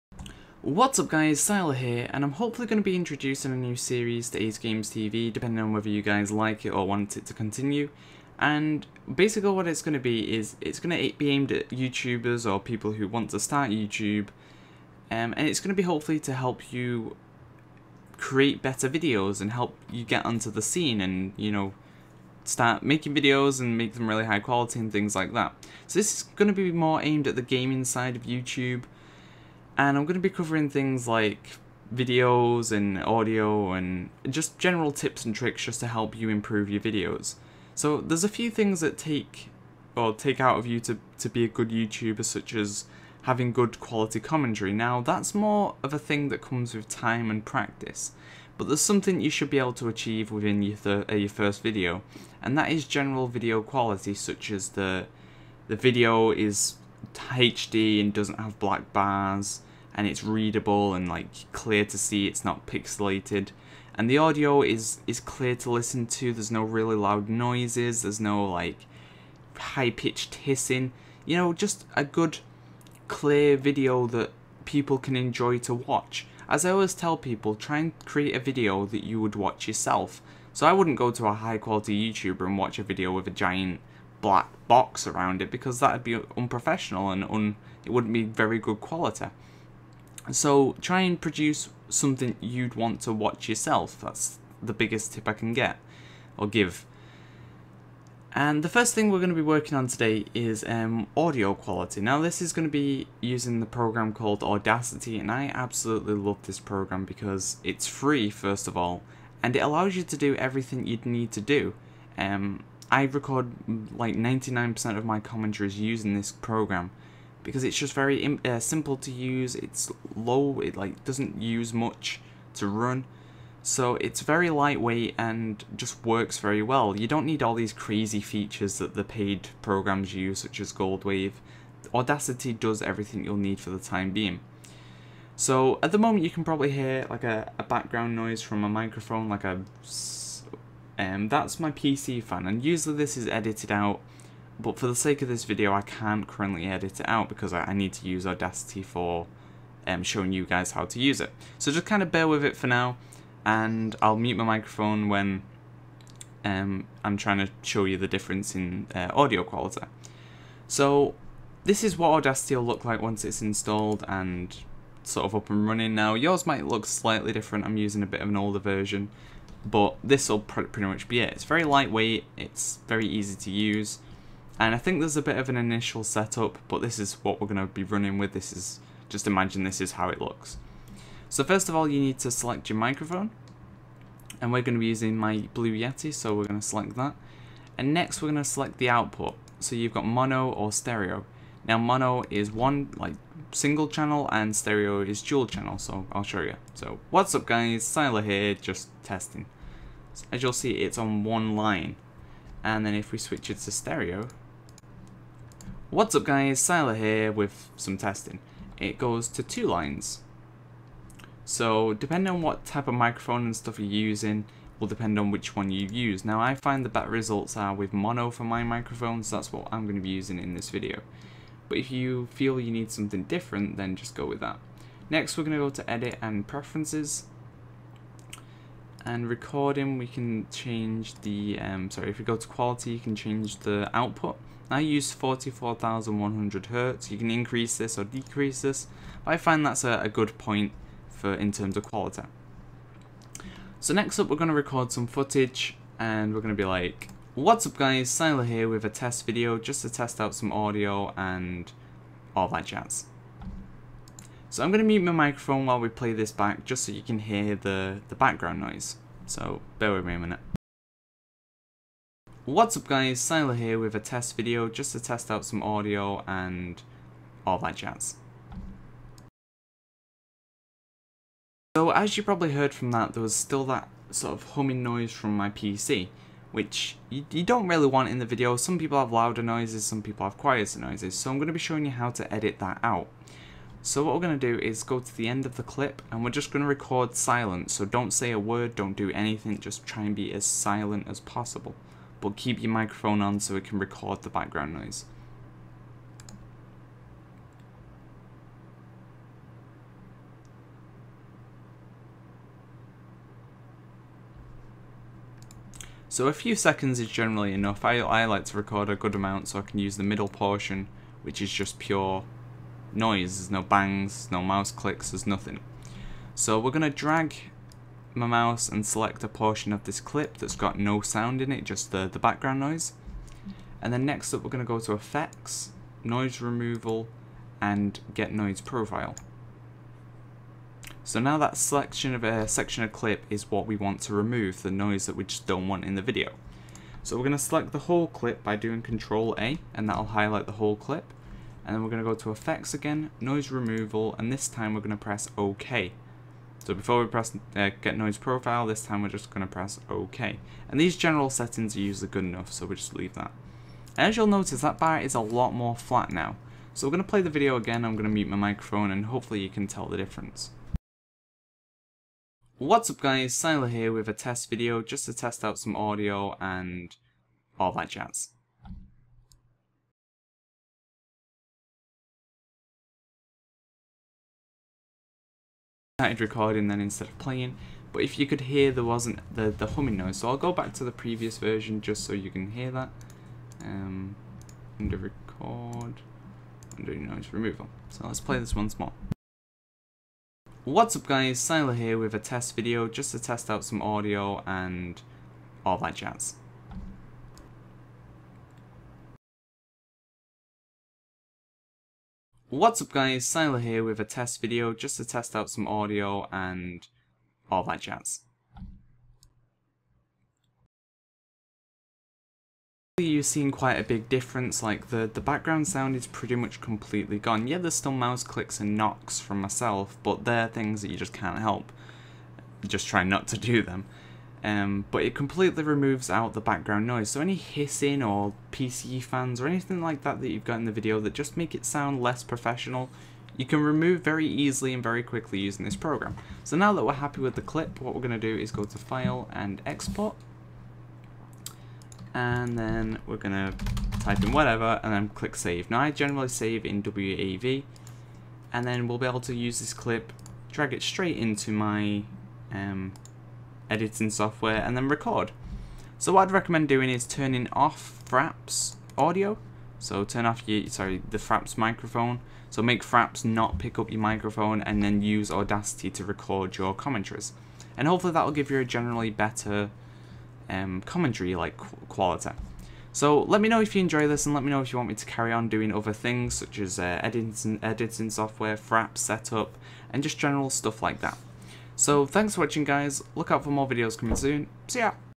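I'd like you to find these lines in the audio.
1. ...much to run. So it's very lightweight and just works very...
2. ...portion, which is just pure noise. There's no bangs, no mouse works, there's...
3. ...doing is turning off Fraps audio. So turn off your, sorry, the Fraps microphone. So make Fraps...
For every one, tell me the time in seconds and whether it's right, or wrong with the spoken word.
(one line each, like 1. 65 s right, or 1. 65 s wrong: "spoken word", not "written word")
1. 121 s right
2. 310 s wrong: "clicks", not "works"
3. 456 s right.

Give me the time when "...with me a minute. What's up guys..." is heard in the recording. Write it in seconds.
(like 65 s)
259 s.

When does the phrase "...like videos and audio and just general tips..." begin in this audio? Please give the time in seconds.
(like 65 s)
31 s.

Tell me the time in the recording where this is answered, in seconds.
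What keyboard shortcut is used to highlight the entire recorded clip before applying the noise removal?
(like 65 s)
338 s.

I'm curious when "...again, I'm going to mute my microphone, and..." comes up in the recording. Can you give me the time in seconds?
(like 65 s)
357 s.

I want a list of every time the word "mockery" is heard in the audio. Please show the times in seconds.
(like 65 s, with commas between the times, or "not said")
not said.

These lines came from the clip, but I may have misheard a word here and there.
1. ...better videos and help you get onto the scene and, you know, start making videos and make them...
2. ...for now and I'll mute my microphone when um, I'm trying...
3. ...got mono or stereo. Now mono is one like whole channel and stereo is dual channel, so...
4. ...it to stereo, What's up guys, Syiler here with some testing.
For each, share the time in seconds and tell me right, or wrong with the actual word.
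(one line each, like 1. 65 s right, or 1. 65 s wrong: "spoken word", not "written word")
1. 18 s right
2. 152 s right
3. 189 s wrong: "single", not "whole"
4. 203 s right.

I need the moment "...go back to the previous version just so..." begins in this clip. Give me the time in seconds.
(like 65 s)
380 s.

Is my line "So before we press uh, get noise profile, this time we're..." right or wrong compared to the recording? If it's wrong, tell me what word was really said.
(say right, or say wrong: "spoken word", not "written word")
right.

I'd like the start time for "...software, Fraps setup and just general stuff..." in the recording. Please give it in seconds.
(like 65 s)
478 s.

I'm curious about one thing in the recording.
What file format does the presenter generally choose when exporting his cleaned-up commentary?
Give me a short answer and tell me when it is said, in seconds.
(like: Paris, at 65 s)
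WAV, at 446 s.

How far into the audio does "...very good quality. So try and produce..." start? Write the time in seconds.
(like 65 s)
88 s.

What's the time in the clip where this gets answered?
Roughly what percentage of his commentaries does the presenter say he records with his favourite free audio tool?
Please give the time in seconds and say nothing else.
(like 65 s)
114 s.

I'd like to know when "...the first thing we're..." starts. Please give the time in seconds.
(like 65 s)
98 s.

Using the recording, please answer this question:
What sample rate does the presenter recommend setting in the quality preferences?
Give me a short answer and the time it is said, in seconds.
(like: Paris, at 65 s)
44,100 Hertz, at 235 s.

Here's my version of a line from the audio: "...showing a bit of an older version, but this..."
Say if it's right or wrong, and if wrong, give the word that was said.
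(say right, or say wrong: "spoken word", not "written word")
wrong: "using", not "showing".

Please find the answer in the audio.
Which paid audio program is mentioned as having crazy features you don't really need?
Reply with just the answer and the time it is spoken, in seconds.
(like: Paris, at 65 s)
Goldwave, at 130 s.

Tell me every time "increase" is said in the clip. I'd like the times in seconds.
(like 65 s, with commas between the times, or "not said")
237 s.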